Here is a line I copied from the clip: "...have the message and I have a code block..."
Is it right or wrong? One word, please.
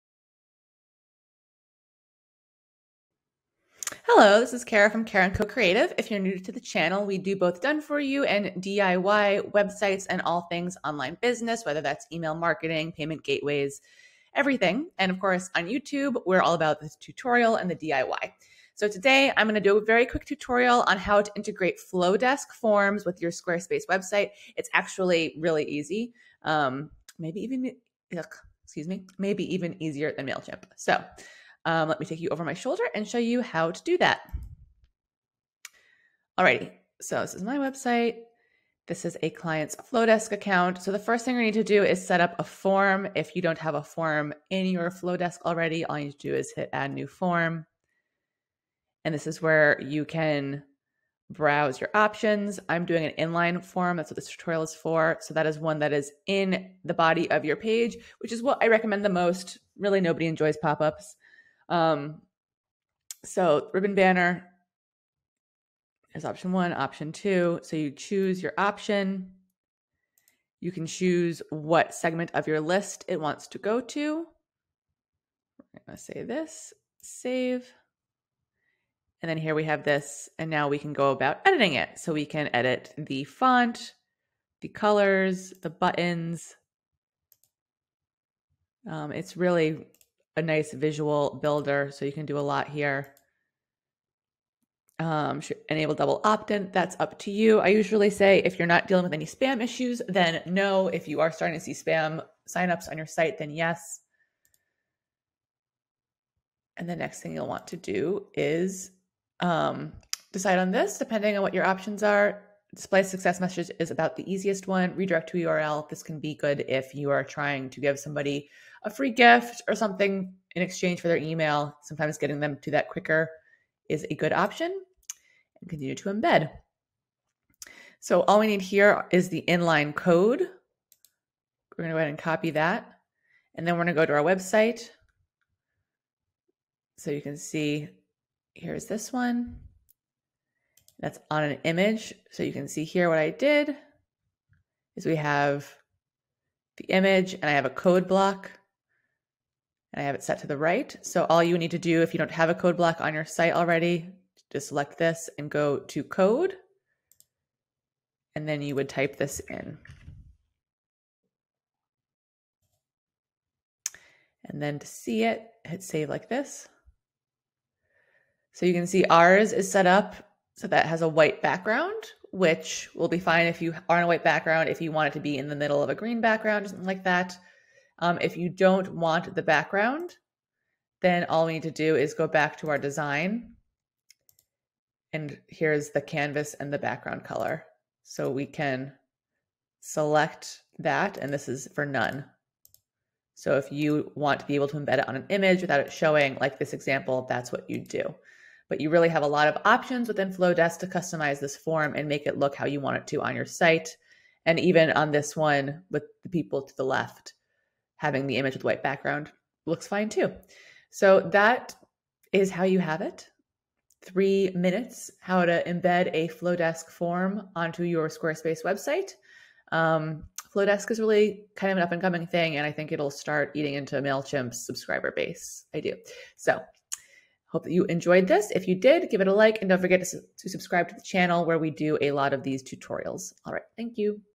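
wrong.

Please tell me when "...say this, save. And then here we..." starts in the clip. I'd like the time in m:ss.
1:15.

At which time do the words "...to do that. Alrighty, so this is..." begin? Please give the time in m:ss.
0:33.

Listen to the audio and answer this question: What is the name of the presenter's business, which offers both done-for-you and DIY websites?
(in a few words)
Karen Co Creative.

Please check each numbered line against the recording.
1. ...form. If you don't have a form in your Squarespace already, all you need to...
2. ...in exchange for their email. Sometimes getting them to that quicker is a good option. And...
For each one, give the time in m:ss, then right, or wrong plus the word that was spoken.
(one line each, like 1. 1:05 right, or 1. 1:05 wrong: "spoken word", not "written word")
1. 0:42 wrong: "FloDesk", not "Squarespace"
2. 2:00 right.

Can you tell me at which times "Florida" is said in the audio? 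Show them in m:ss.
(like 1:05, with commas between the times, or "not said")
not said.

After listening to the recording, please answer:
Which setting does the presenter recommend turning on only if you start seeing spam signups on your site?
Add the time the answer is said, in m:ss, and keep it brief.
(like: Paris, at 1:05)
Double opt-in, at 1:35.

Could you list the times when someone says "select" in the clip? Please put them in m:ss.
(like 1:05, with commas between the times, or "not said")
2:34, 3:09.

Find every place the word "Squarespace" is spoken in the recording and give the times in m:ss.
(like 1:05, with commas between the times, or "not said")
0:23, 3:38.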